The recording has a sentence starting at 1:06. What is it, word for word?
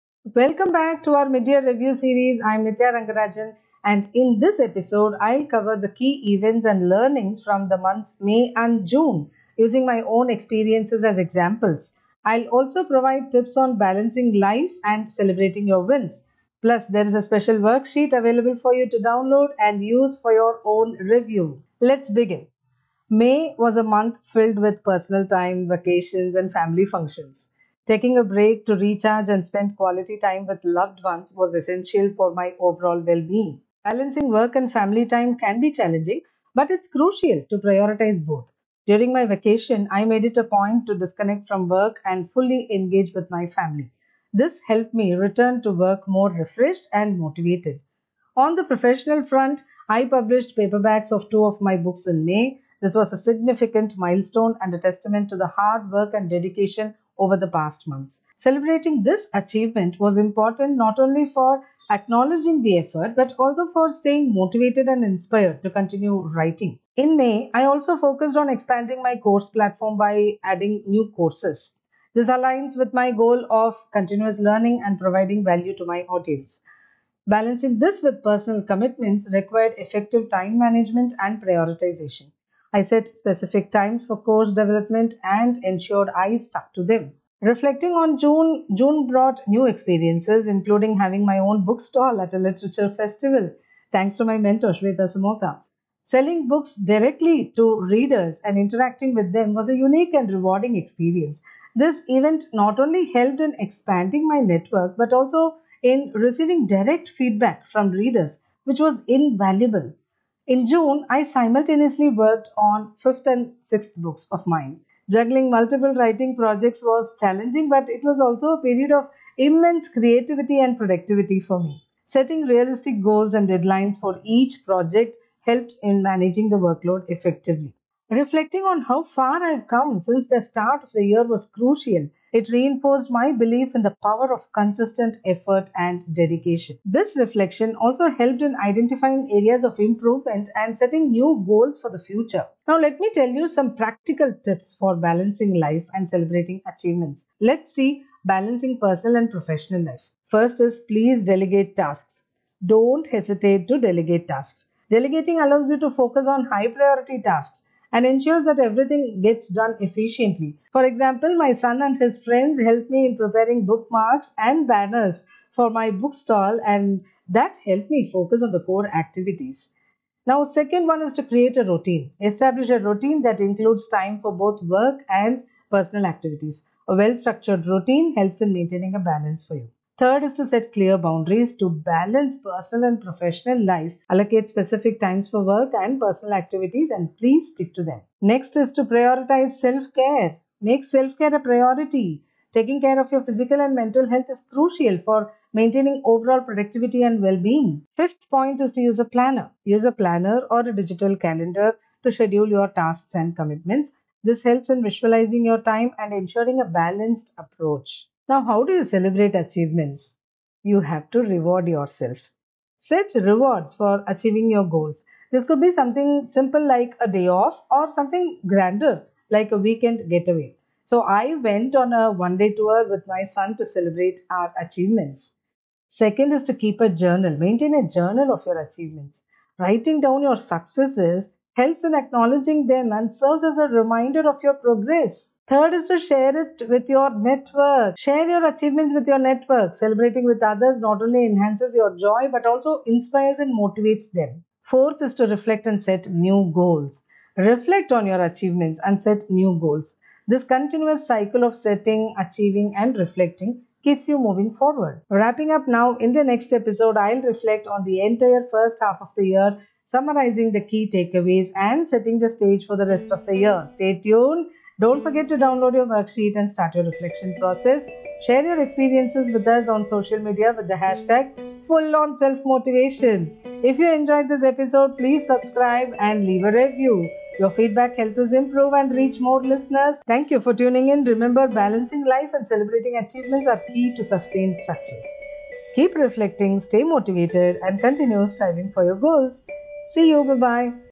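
In May, I also focused on expanding my course platform by adding new courses.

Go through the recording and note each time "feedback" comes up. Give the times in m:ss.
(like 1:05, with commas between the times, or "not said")
1:47, 4:37.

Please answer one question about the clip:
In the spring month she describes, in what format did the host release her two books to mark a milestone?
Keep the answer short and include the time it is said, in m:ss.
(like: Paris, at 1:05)
Paperbacks, at 0:50.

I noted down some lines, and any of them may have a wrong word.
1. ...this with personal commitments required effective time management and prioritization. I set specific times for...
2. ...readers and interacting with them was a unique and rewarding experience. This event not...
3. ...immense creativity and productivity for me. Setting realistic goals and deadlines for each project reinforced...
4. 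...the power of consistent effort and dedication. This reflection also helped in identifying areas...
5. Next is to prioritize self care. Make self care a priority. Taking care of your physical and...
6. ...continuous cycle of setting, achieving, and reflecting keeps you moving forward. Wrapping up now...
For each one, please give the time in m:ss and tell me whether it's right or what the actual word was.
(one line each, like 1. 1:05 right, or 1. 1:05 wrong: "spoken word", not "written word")
1. 1:17 right
2. 1:37 right
3. 1:59 wrong: "helped", not "reinforced"
4. 2:13 right
5. 3:08 right
6. 4:10 right.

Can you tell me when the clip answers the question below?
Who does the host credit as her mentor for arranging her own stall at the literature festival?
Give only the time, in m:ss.
1:34.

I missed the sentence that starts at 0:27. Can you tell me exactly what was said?
Taking a break to recharge and spend quality time with loved ones was essential for my overall well being.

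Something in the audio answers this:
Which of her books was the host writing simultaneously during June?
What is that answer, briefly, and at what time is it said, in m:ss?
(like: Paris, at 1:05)
5th and 6th, at 1:52.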